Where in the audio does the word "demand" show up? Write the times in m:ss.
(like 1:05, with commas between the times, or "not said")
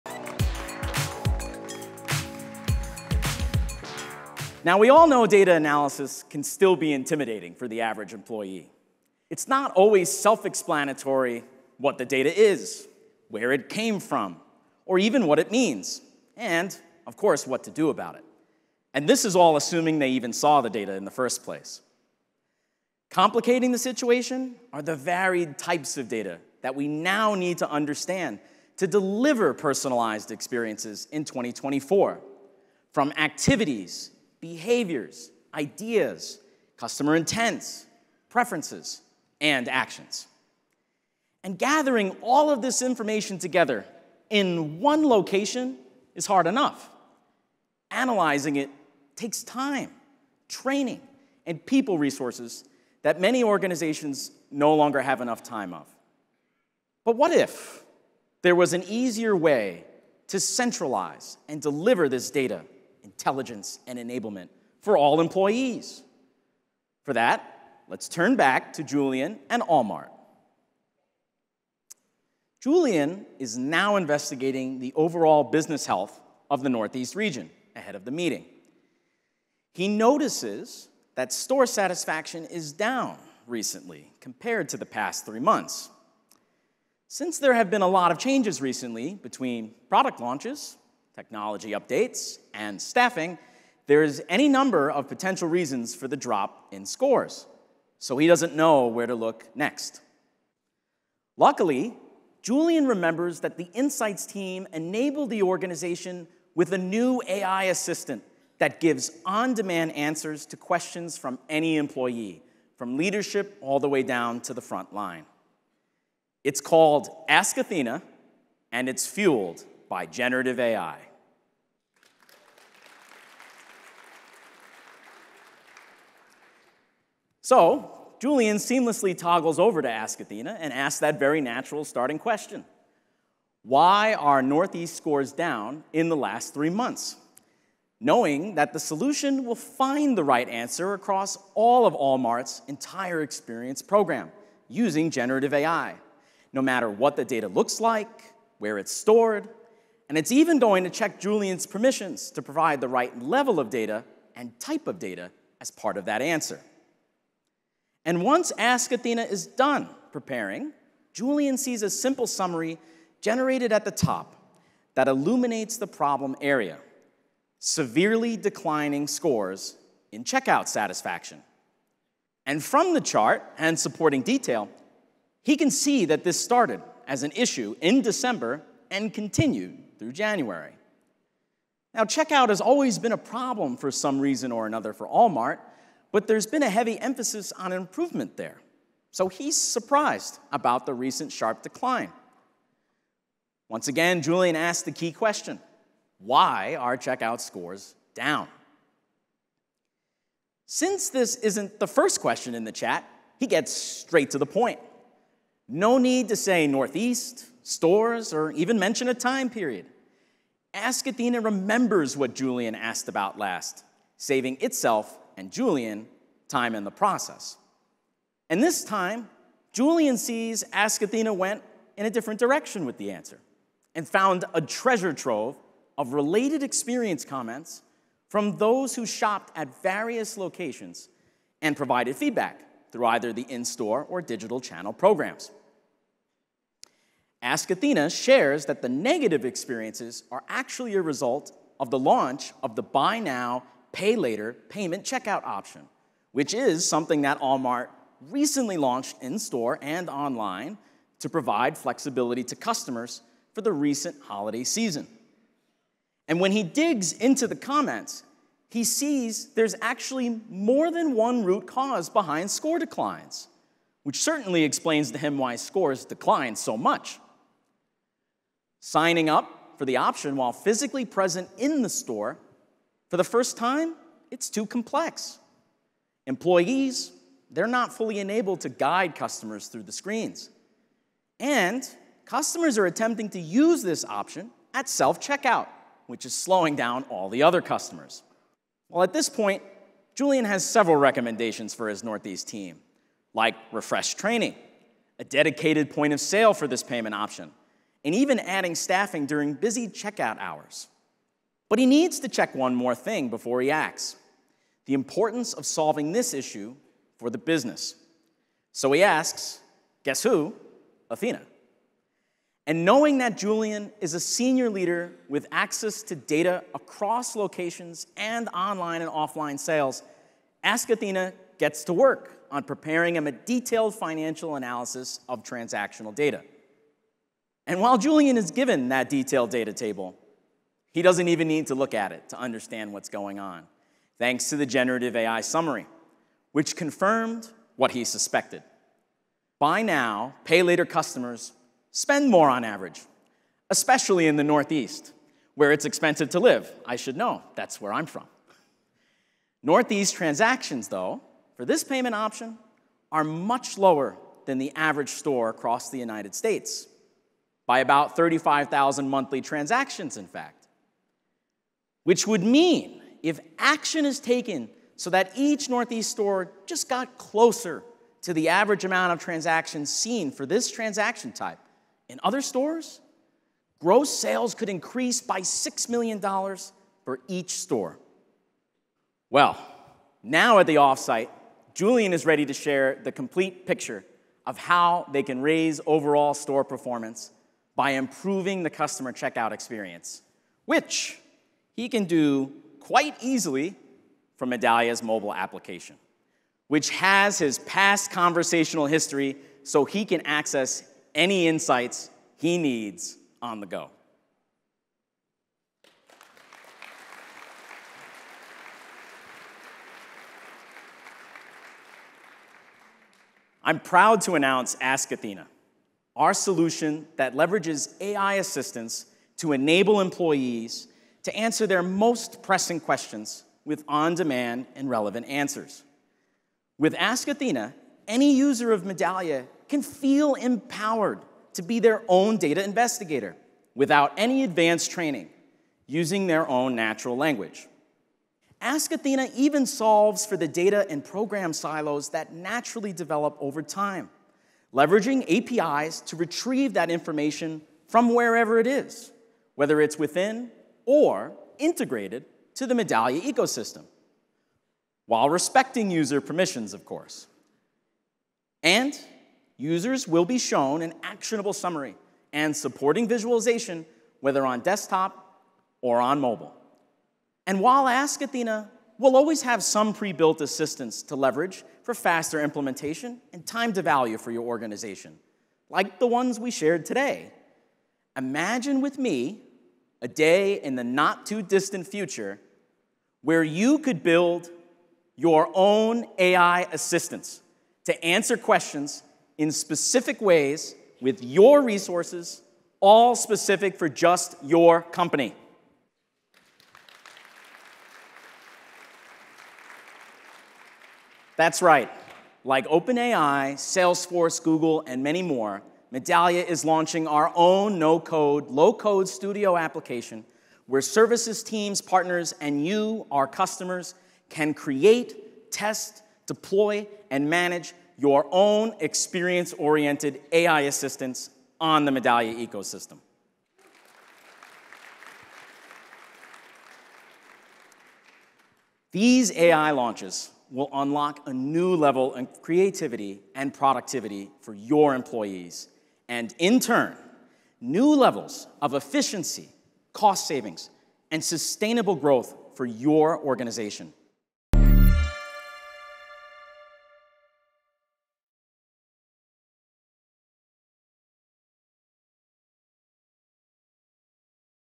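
1:49, 7:04.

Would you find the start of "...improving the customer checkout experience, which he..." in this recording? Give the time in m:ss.
6:27.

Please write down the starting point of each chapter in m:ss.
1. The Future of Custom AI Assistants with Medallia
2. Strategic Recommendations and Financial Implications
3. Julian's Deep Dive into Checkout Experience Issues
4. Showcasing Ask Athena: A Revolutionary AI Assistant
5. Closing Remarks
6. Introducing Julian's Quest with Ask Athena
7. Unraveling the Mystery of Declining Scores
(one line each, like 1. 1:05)
1. 8:07
2. 4:53
3. 3:18
4. 6:58
5. 9:08
6. 1:11
7. 2:18.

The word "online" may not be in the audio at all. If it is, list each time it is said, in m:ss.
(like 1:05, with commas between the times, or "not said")
4:10, 5:18.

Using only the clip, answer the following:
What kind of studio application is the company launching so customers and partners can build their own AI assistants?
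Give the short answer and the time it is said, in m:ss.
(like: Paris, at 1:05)
No code, low code, at 8:27.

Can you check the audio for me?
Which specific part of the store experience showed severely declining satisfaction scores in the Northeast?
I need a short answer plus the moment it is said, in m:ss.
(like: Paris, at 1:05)
Checkout satisfaction, at 2:50.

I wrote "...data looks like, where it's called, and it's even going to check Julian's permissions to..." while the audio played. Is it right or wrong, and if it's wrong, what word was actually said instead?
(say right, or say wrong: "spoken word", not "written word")
wrong: "stored", not "called".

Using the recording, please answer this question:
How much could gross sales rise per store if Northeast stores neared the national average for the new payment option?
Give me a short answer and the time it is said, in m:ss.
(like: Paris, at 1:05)
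$6 million, at 6:15.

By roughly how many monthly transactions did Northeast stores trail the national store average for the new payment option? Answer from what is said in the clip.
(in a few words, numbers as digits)
35,000.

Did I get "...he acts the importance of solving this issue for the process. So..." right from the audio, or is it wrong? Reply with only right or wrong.
wrong.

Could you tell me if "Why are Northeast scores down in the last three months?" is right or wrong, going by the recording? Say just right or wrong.
right.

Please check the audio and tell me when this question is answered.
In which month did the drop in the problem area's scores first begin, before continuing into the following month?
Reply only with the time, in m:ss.
2:58.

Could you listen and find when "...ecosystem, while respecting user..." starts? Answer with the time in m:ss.
7:33.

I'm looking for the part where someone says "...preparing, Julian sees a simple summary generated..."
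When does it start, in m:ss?
2:40.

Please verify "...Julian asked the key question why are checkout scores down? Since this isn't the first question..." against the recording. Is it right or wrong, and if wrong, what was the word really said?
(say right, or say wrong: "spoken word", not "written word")
right.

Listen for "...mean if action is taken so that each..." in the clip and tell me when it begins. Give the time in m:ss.
6:02.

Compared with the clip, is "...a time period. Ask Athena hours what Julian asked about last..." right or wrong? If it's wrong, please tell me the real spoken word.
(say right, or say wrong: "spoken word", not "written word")
wrong: "remembers", not "hours".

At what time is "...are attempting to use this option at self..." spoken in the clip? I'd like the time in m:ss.
4:42.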